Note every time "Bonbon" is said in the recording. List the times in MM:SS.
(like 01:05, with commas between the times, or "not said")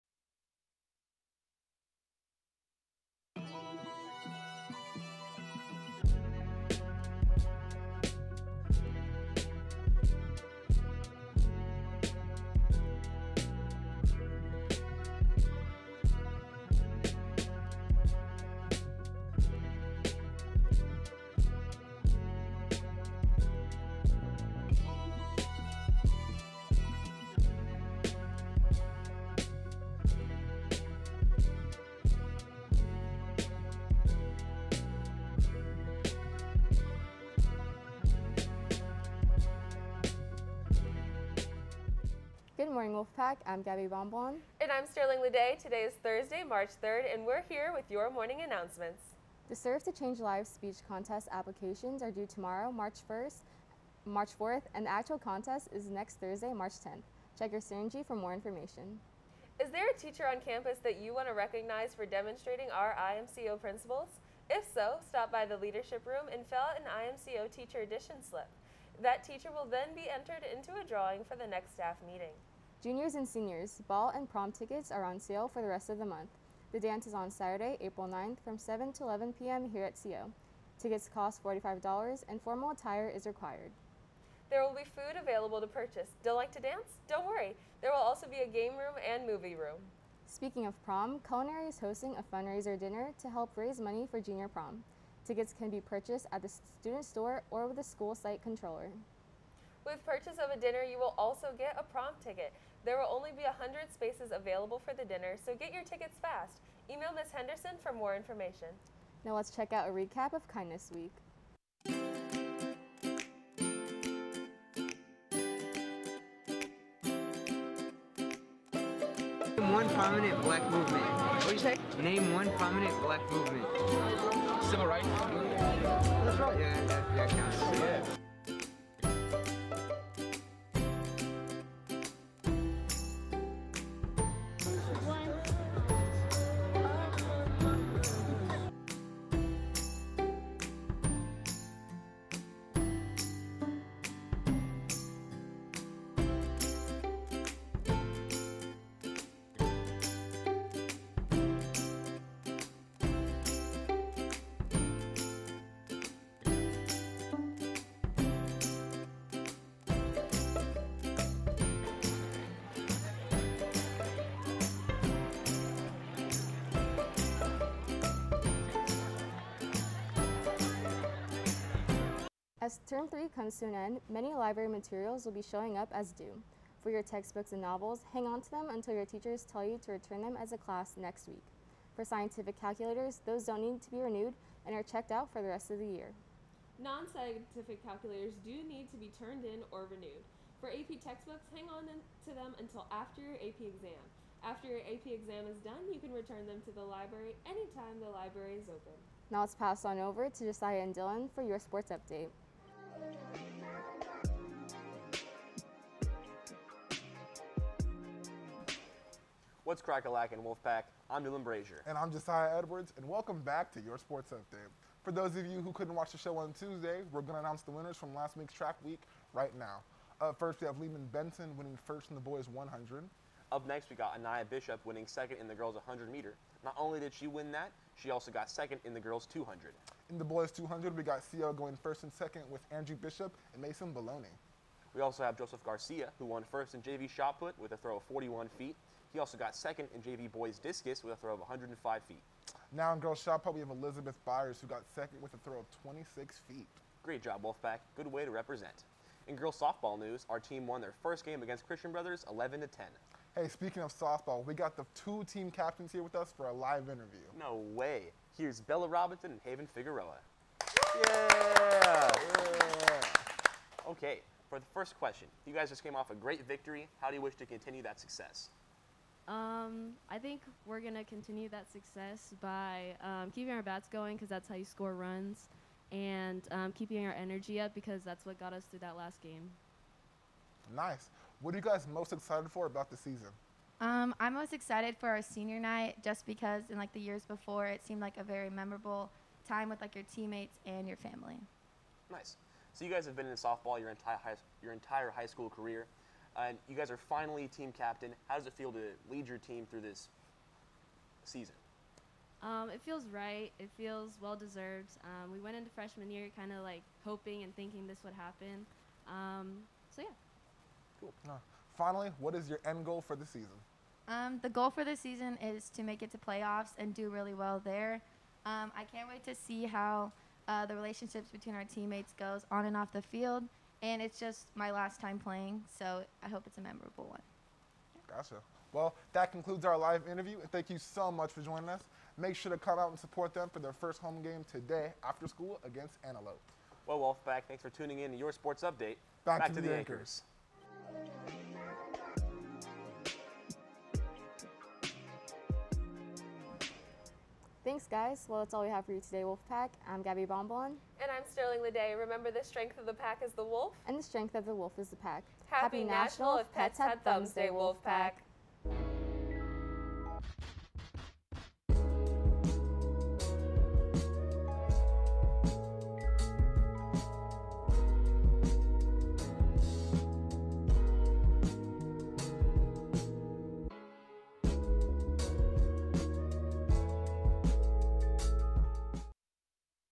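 00:43, 05:50.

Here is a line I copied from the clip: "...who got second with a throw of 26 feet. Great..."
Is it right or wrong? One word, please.
right.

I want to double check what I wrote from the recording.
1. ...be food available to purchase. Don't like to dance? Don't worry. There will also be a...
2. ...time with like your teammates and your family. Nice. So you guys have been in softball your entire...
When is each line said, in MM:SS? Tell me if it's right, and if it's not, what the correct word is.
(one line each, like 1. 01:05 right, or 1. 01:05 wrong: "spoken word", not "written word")
1. 01:24 right
2. 04:49 right.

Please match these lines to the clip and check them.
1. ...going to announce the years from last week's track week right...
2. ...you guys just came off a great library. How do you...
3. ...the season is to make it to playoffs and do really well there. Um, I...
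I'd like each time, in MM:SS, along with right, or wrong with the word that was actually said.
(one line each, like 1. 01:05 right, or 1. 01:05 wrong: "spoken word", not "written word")
1. 03:37 wrong: "winners", not "years"
2. 04:25 wrong: "victory", not "library"
3. 05:14 right.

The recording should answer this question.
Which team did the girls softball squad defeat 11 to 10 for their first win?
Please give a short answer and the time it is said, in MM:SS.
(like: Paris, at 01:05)
Christian Brothers, at 04:11.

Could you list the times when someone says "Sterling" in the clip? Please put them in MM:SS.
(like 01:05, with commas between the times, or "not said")
00:44, 05:51.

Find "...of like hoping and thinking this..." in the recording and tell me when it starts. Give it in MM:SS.
05:06.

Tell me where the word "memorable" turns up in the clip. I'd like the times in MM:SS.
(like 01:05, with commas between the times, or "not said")
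04:48, 05:26.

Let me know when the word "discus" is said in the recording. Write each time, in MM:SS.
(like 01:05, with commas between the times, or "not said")
04:00.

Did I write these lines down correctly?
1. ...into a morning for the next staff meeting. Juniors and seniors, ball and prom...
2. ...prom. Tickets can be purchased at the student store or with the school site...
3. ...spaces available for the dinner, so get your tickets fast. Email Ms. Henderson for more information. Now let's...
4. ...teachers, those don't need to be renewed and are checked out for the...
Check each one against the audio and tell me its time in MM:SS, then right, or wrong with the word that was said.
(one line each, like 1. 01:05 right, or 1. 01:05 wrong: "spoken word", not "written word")
1. 01:10 wrong: "drawing", not "morning"
2. 01:34 right
3. 01:43 right
4. 03:02 wrong: "calculators", not "teachers".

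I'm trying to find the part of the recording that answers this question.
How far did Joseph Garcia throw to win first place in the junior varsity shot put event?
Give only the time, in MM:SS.
03:58.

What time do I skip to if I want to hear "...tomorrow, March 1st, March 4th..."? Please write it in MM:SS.
00:52.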